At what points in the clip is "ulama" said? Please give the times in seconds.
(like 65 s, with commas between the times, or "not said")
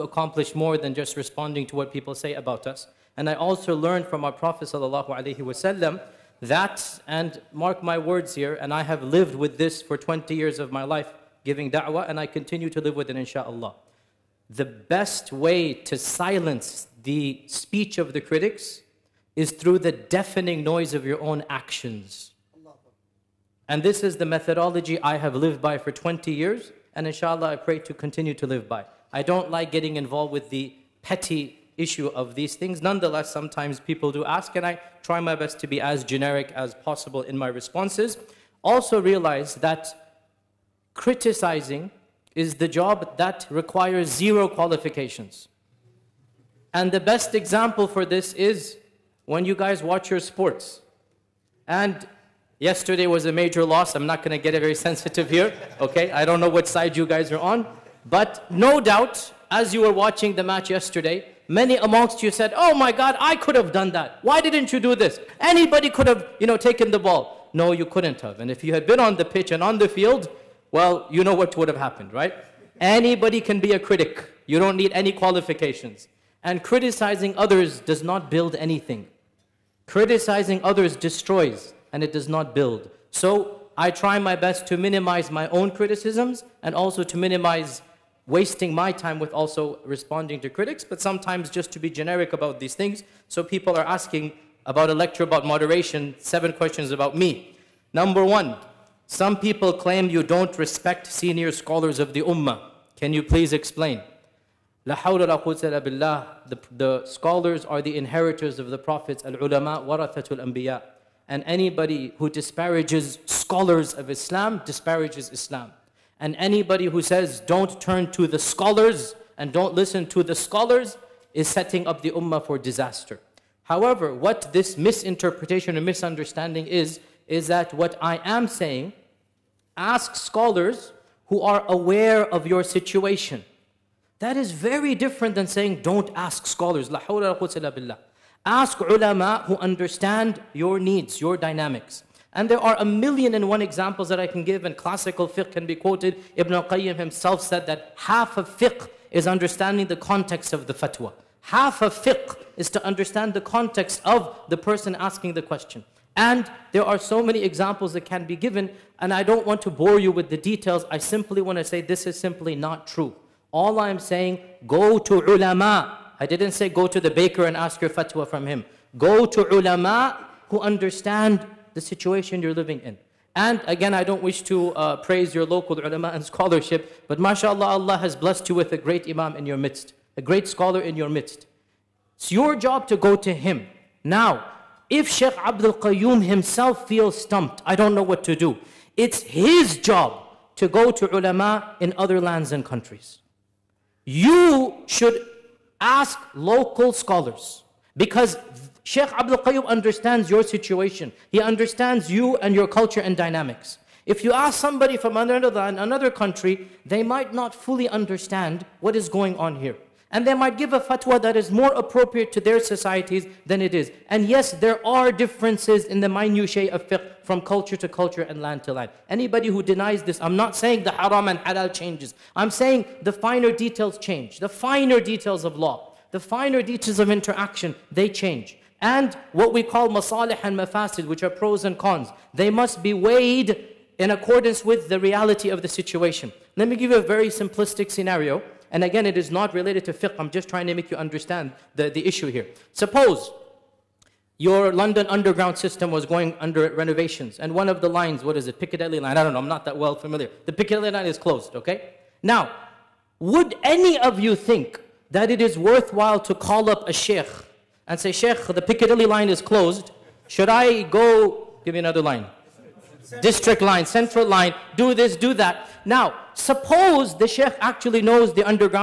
109 s, 138 s, 165 s, 169 s, 175 s, 191 s.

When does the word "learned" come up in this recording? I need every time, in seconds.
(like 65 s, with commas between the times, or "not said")
3 s.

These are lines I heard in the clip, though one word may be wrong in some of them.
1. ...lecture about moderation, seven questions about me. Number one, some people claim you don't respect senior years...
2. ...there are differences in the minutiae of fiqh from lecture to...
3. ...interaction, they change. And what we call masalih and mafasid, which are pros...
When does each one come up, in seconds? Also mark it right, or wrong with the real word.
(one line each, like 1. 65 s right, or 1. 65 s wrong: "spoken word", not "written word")
1. 94 s wrong: "scholars", not "years"
2. 214 s wrong: "culture", not "lecture"
3. 227 s right.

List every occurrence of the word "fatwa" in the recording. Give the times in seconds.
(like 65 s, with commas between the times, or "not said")
150 s, 167 s, 210 s.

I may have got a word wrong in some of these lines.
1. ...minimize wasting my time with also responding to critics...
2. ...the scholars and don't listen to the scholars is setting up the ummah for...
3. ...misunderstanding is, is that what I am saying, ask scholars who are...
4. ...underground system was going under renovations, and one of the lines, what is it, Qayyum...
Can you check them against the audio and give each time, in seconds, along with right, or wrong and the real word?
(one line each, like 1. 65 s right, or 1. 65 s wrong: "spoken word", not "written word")
1. 87 s right
2. 118 s right
3. 125 s right
4. 245 s wrong: "Piccadilly", not "Qayyum".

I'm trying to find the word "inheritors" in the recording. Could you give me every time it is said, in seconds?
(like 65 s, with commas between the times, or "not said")
107 s.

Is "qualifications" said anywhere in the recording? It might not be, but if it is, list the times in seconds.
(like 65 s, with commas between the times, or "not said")
44 s, 75 s.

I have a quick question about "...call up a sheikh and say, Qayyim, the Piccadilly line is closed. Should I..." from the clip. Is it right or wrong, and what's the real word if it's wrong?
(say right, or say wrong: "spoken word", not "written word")
wrong: "Sheikh", not "Qayyim".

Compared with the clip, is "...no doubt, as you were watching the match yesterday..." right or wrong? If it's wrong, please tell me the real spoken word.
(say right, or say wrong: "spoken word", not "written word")
right.